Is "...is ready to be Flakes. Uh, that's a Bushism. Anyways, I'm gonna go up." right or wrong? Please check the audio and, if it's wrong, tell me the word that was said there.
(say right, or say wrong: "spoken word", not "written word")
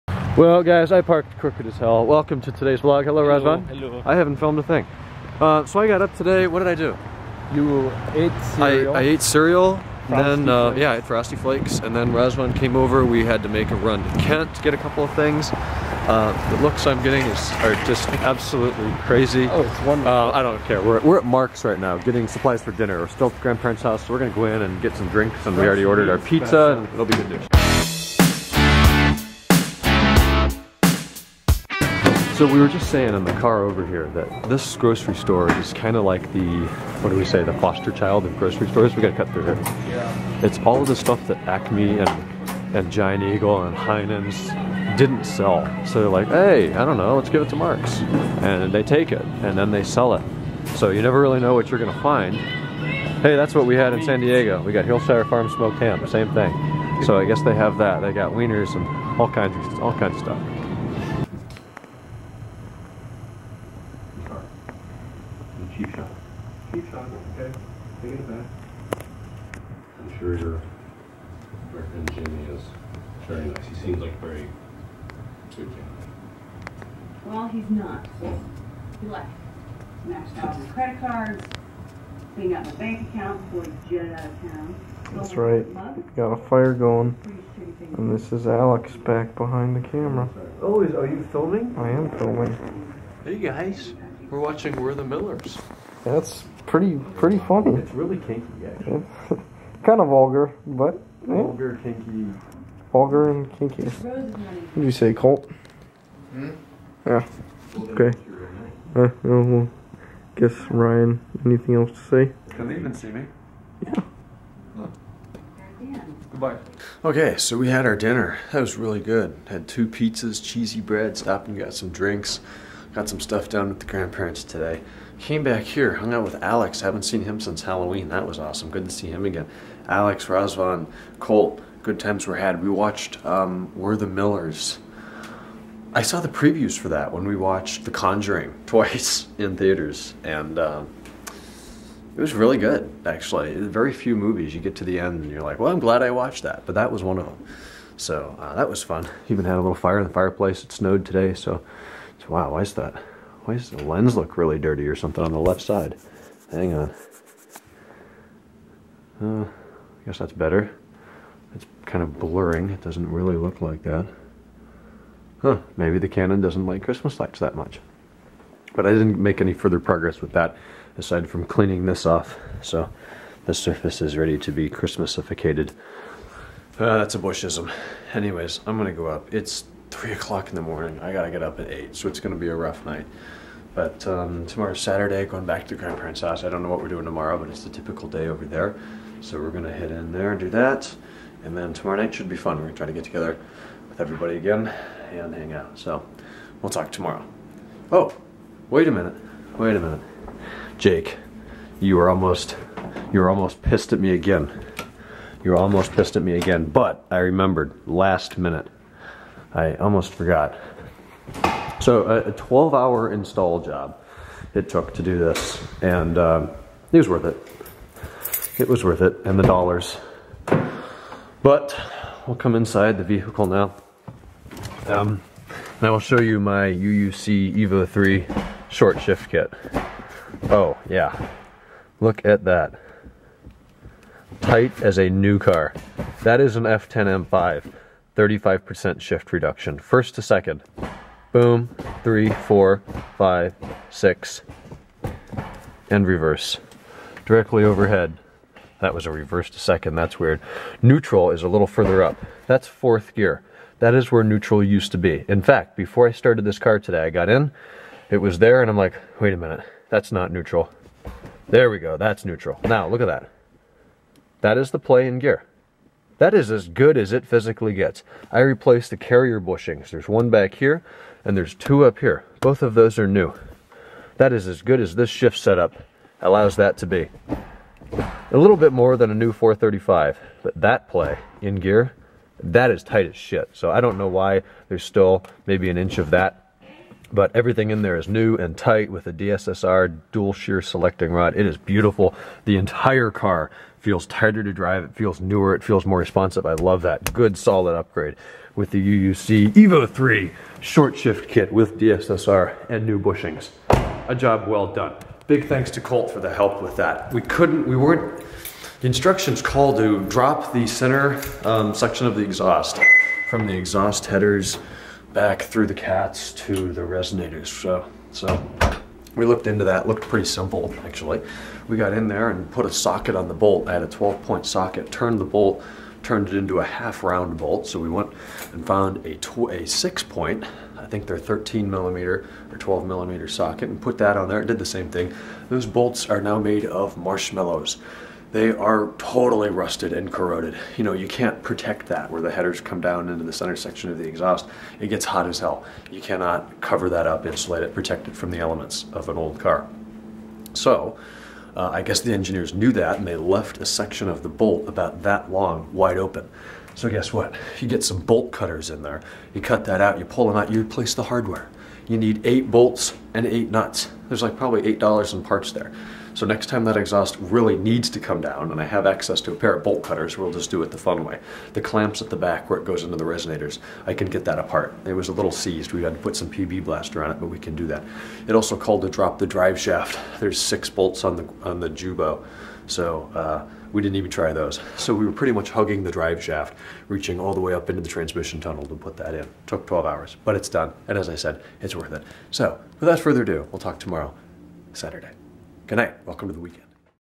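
wrong: "Christmasificated", not "Flakes".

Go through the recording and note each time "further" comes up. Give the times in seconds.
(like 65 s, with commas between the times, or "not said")
169 s, 251 s, 392 s.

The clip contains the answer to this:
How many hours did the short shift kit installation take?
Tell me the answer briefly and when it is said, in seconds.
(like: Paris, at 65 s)
12, at 212 s.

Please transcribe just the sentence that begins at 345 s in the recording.
You cannot cover that up, insulate it, protect it from the elements of an old car.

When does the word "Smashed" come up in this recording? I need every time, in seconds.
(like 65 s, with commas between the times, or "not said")
80 s.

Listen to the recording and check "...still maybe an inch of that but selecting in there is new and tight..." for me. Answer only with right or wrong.
wrong.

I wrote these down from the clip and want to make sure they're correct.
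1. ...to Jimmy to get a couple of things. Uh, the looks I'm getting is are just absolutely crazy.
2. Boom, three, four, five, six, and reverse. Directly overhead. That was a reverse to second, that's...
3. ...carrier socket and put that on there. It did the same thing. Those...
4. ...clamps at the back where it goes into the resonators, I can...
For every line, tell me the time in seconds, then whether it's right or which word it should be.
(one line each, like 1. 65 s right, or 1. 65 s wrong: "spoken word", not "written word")
1. 14 s wrong: "Kent", not "Jimmy"
2. 241 s right
3. 332 s wrong: "millimeter", not "carrier"
4. 371 s right.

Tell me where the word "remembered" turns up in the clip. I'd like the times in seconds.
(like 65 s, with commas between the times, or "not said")
207 s.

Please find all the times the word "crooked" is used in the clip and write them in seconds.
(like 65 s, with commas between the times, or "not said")
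1 s.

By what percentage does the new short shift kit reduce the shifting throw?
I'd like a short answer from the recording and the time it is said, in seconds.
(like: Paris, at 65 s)
35%, at 238 s.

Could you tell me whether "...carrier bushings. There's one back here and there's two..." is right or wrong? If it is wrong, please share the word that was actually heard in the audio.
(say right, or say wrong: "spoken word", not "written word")
right.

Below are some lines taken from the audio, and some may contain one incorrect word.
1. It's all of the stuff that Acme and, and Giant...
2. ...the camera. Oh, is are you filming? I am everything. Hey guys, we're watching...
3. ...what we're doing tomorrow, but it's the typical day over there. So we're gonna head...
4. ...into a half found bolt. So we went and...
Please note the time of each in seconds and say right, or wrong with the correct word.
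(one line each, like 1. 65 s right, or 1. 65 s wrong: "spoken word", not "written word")
1. 40 s right
2. 89 s wrong: "filming", not "everything"
3. 186 s right
4. 326 s wrong: "round", not "found".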